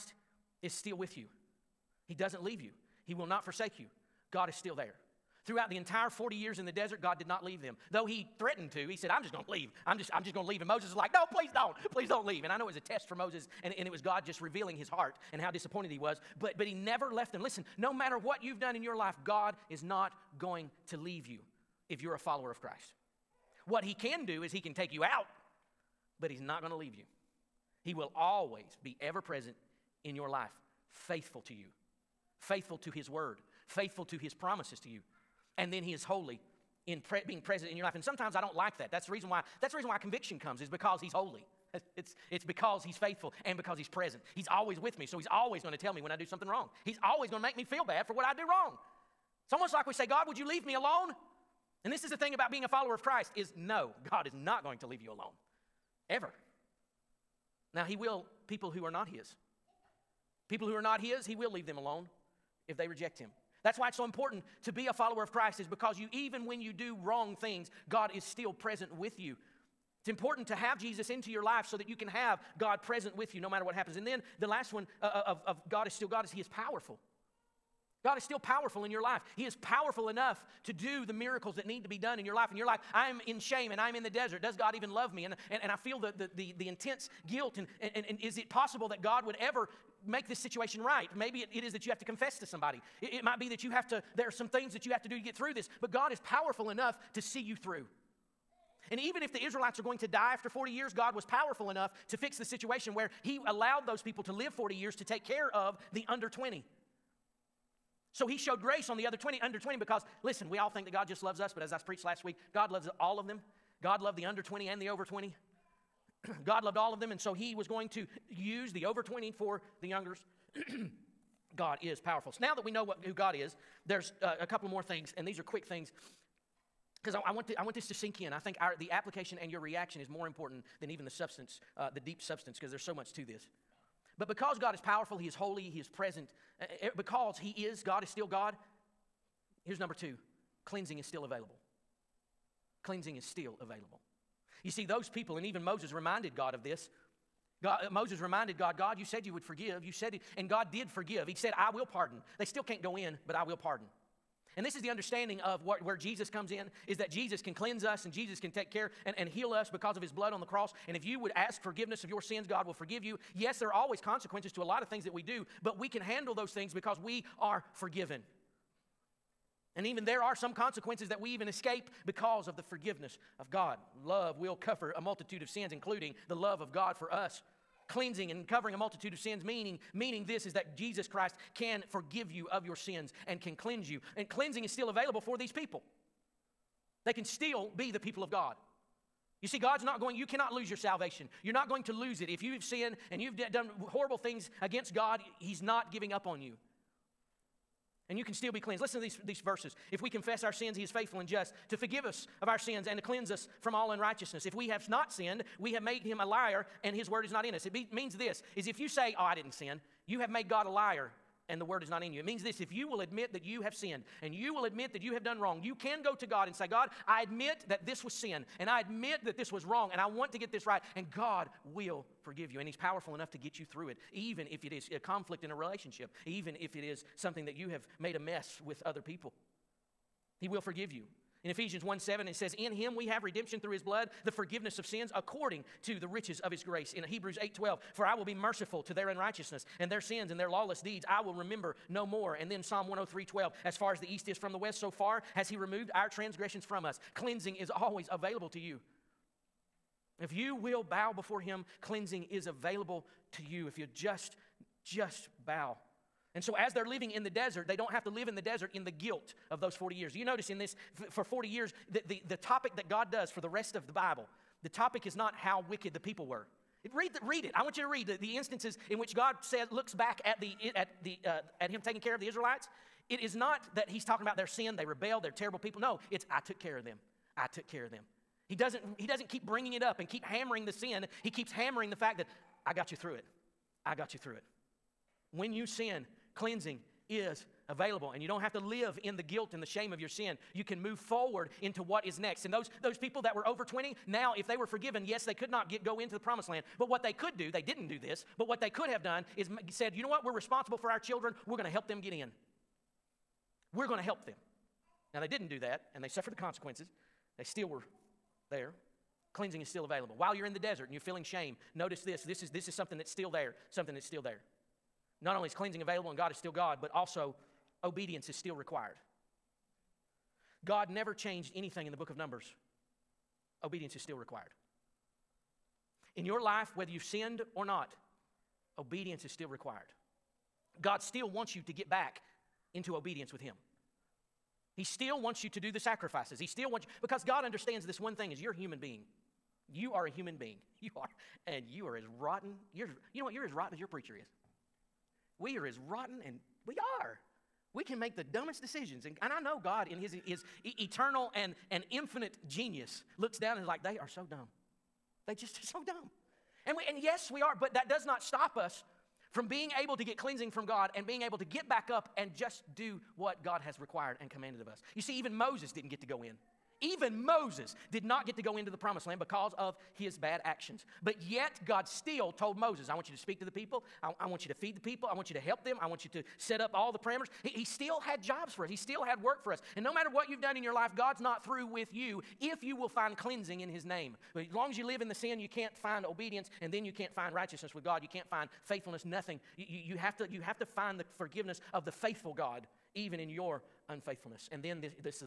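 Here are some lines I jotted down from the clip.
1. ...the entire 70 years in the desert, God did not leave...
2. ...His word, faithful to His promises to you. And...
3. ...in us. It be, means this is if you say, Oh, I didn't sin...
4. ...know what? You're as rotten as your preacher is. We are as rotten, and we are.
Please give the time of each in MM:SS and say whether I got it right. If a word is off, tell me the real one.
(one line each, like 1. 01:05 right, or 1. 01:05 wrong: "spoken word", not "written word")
1. 00:05 wrong: "40", not "70"
2. 00:32 right
3. 03:27 right
4. 05:43 right.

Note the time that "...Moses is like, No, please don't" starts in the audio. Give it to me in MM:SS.
00:10.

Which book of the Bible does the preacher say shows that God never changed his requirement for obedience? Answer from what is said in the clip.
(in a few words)
Numbers.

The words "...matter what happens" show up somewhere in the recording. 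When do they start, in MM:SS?
01:13.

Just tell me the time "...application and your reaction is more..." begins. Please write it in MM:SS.
02:08.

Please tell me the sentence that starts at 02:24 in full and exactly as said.
You see, those people, and even Moses reminded God of this.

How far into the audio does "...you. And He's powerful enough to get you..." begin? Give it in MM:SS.
03:42.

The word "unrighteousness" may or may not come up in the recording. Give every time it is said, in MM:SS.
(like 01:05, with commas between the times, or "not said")
03:23, 03:59.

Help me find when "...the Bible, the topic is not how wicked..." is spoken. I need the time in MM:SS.
04:23.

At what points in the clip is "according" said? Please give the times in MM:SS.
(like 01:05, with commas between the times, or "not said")
03:55.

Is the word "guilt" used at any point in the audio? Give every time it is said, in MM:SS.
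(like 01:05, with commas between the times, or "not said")
01:27, 04:18, 04:49.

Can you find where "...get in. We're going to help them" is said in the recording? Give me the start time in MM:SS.
05:01.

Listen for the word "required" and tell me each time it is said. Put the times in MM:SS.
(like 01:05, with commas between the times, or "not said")
05:18, 05:24, 05:29, 06:03.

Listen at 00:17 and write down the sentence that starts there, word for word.
Listen, no matter what you've done in your life, God is not going to leave you if you're a follower of Christ.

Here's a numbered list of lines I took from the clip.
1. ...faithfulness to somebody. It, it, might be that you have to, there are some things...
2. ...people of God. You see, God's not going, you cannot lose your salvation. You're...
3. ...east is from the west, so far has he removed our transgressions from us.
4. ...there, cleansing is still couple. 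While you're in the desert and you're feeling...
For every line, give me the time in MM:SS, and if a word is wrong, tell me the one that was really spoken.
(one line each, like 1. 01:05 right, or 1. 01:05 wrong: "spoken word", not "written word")
1. 01:32 wrong: "confess", not "faithfulness"
2. 03:07 right
3. 04:04 right
4. 05:08 wrong: "available", not "couple".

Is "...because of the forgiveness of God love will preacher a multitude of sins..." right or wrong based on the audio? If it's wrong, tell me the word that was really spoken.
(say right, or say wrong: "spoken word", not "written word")
wrong: "cover", not "preacher".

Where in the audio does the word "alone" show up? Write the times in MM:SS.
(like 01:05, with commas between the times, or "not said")
00:50, 00:55, 01:01.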